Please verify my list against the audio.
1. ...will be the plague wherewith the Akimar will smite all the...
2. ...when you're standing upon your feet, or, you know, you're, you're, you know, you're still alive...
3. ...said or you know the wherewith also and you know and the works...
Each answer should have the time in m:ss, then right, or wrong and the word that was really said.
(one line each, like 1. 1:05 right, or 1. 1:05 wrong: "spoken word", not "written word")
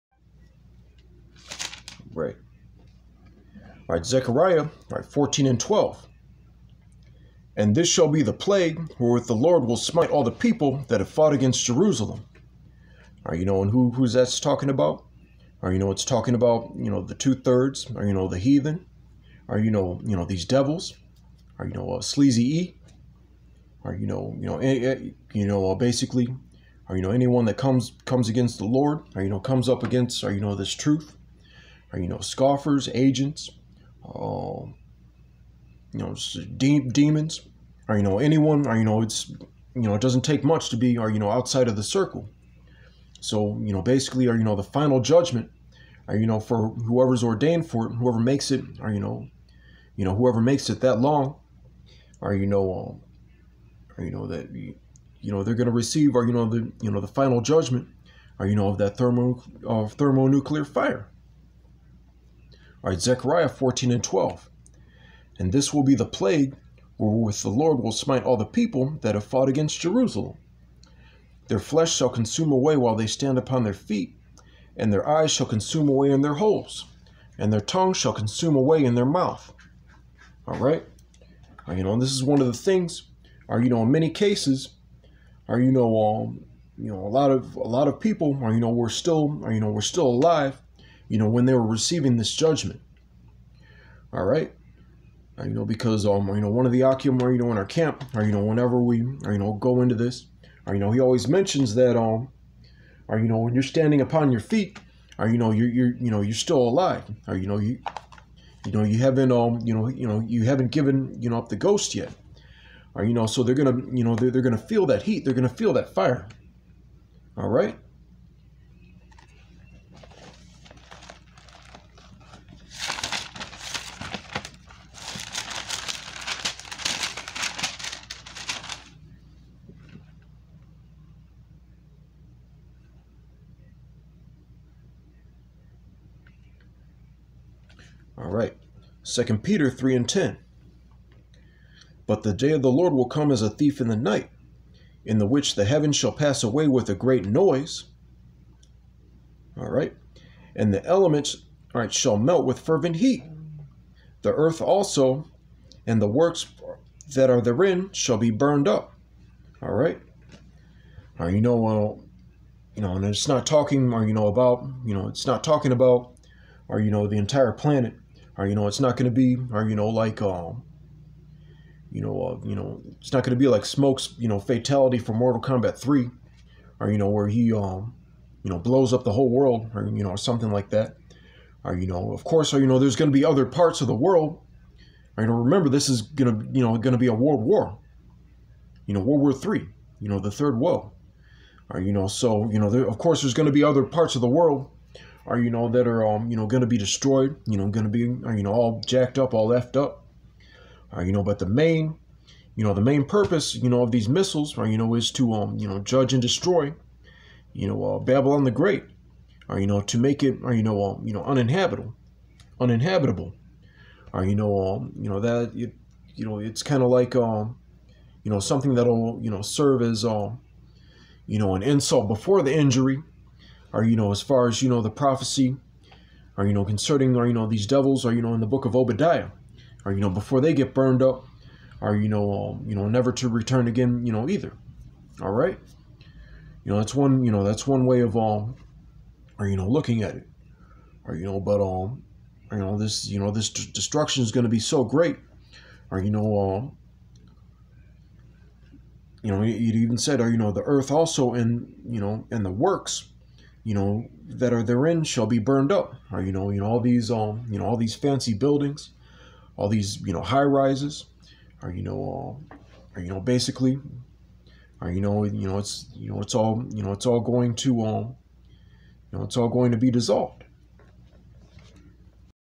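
1. 1:05 wrong: "Lord", not "Akimar"
2. 1:43 right
3. 4:09 wrong: "earth", not "wherewith".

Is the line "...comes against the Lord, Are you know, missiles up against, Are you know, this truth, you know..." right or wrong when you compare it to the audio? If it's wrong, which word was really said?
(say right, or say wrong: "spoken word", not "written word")
wrong: "comes", not "missiles".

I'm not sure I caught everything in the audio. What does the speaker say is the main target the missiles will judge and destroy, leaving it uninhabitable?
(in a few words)
Babylon the Great.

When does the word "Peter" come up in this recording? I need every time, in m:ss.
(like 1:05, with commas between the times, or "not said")
2:19.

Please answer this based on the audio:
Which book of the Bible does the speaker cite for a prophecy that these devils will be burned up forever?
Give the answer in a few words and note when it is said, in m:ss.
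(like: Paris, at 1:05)
Obadiah, at 3:48.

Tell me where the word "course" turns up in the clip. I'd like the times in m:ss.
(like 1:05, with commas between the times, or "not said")
3:02, 3:12.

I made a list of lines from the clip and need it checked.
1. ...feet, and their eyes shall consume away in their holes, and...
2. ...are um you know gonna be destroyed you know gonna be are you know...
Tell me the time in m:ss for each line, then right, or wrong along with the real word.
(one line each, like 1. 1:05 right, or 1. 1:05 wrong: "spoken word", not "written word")
1. 1:13 right
2. 3:15 right.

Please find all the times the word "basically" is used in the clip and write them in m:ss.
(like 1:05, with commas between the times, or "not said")
0:25, 0:43, 4:23.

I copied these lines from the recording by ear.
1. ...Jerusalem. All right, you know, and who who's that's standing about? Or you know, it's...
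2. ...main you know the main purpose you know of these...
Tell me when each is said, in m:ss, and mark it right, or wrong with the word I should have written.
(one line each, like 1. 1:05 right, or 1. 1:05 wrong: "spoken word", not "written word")
1. 0:11 wrong: "talking", not "standing"
2. 3:21 right.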